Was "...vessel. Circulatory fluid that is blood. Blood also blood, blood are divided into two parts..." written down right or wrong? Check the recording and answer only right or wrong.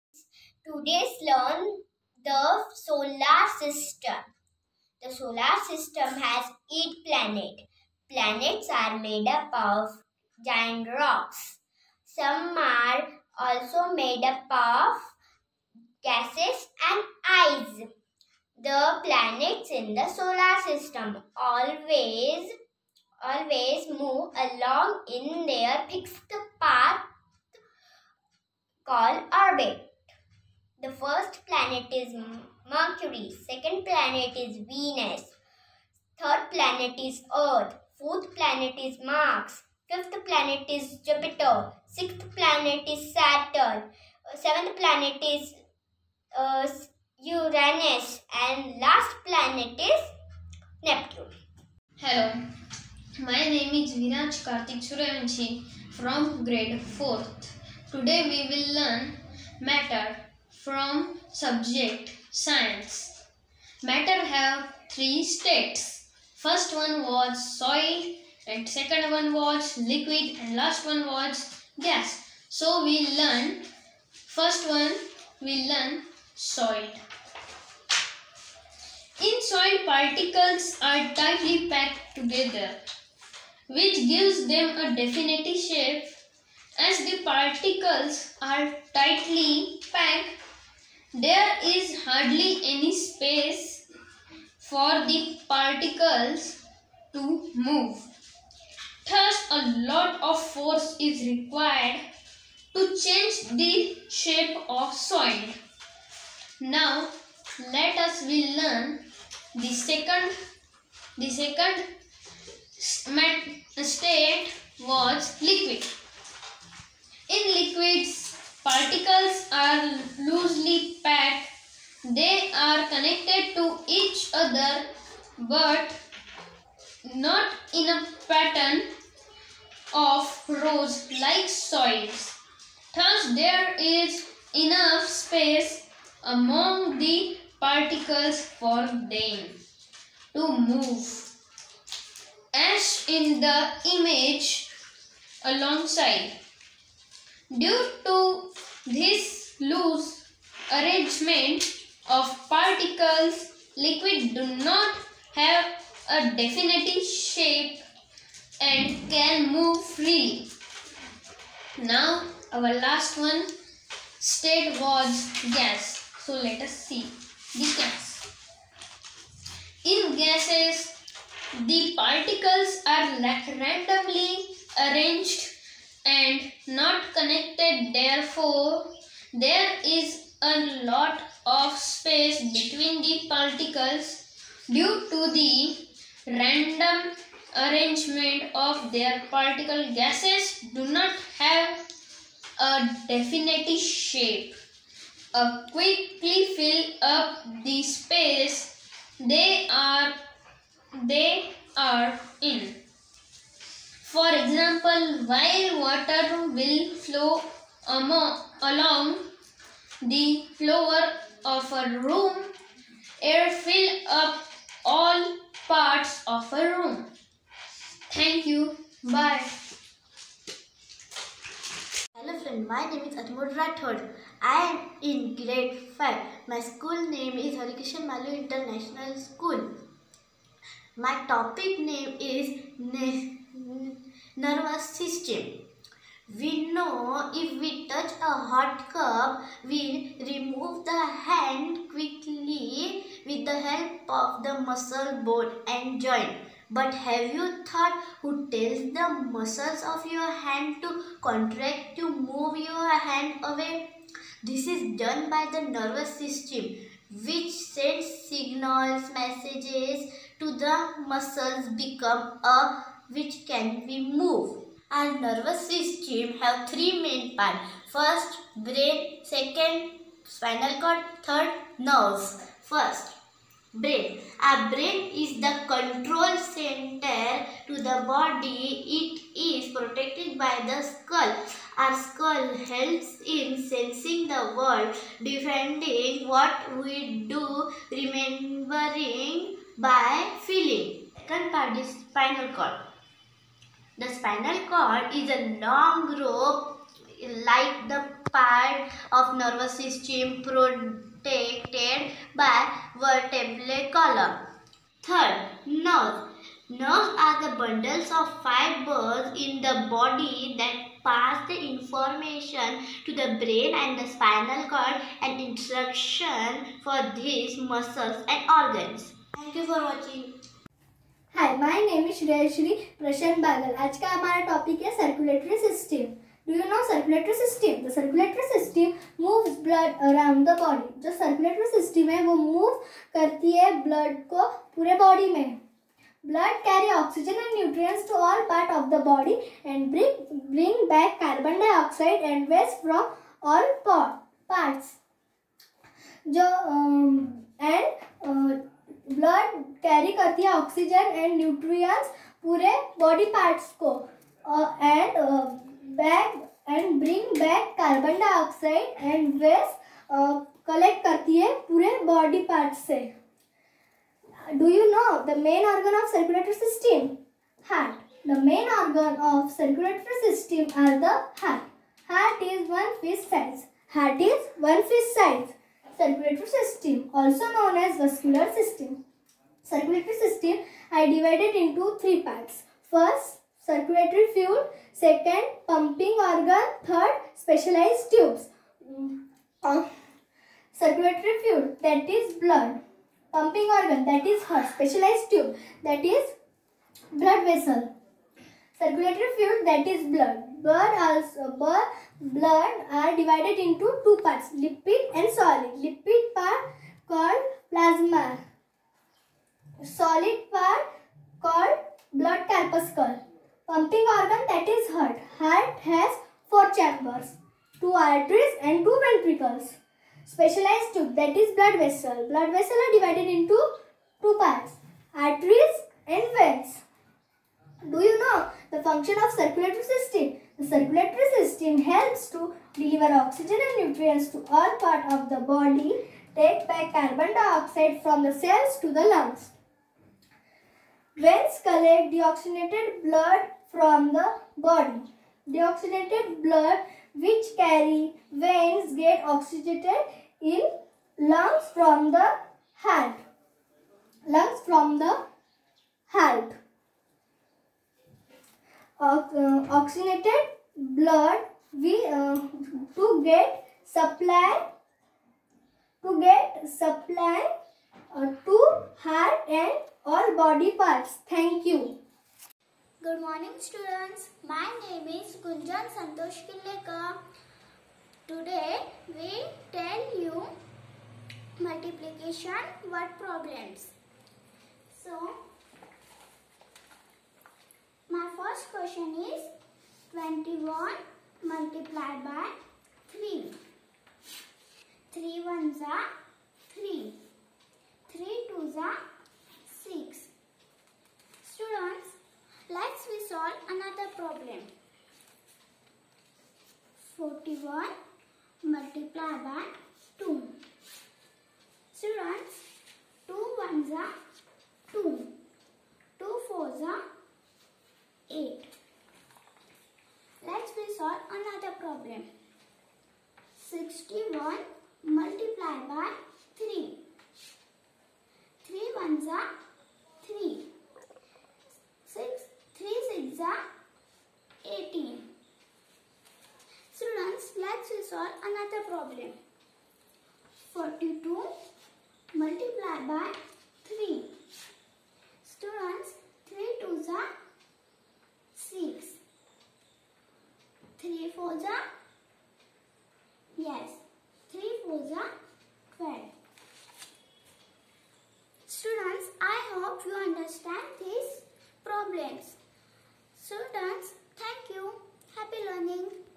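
right.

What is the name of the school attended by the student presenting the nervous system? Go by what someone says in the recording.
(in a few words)
Harikishan Maloo International School.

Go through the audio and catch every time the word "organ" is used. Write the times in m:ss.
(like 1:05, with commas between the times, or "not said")
5:18, 6:26, 6:33, 6:54.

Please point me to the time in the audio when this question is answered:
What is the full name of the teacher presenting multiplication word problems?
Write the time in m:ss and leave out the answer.
7:55.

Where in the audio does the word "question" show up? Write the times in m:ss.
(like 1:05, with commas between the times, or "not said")
8:08.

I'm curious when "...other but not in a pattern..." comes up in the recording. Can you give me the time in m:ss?
2:04.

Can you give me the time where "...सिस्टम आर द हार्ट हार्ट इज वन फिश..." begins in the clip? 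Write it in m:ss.
6:10.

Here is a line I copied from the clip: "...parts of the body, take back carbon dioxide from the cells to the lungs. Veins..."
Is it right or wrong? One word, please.
right.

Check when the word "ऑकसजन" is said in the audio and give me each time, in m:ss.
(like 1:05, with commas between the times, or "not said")
5:36, 5:50.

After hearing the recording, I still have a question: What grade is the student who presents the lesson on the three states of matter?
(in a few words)
Grade 4.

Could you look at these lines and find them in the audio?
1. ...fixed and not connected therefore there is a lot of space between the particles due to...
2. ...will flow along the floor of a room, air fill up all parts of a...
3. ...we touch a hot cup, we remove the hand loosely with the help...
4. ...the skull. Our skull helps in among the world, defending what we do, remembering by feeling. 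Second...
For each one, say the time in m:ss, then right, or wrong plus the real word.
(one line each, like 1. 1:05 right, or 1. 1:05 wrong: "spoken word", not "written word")
1. 2:54 wrong: "arranged", not "fixed"
2. 3:26 right
3. 3:57 wrong: "quickly", not "loosely"
4. 4:40 wrong: "sensing", not "among".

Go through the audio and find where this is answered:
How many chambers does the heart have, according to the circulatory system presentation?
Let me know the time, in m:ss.
6:56.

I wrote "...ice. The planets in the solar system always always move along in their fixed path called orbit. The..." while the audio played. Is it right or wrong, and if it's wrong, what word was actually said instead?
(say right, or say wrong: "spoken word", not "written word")
right.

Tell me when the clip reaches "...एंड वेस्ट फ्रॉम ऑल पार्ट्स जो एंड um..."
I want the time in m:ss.
5:42.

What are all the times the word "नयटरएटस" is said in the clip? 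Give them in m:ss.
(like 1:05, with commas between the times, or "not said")
5:37, 5:51.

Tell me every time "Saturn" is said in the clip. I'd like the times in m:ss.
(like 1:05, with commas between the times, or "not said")
0:43.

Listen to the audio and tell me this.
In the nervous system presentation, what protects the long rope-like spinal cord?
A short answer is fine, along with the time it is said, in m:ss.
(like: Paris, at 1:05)
Vertebral column, at 5:02.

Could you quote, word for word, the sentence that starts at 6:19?
Circulatory system I divided into three parts.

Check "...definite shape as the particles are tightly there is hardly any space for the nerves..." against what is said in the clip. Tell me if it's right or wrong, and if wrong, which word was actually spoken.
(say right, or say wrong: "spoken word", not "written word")
wrong: "particles", not "nerves".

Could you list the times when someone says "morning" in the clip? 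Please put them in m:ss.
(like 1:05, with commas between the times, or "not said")
7:53.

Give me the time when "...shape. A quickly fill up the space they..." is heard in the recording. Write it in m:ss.
3:13.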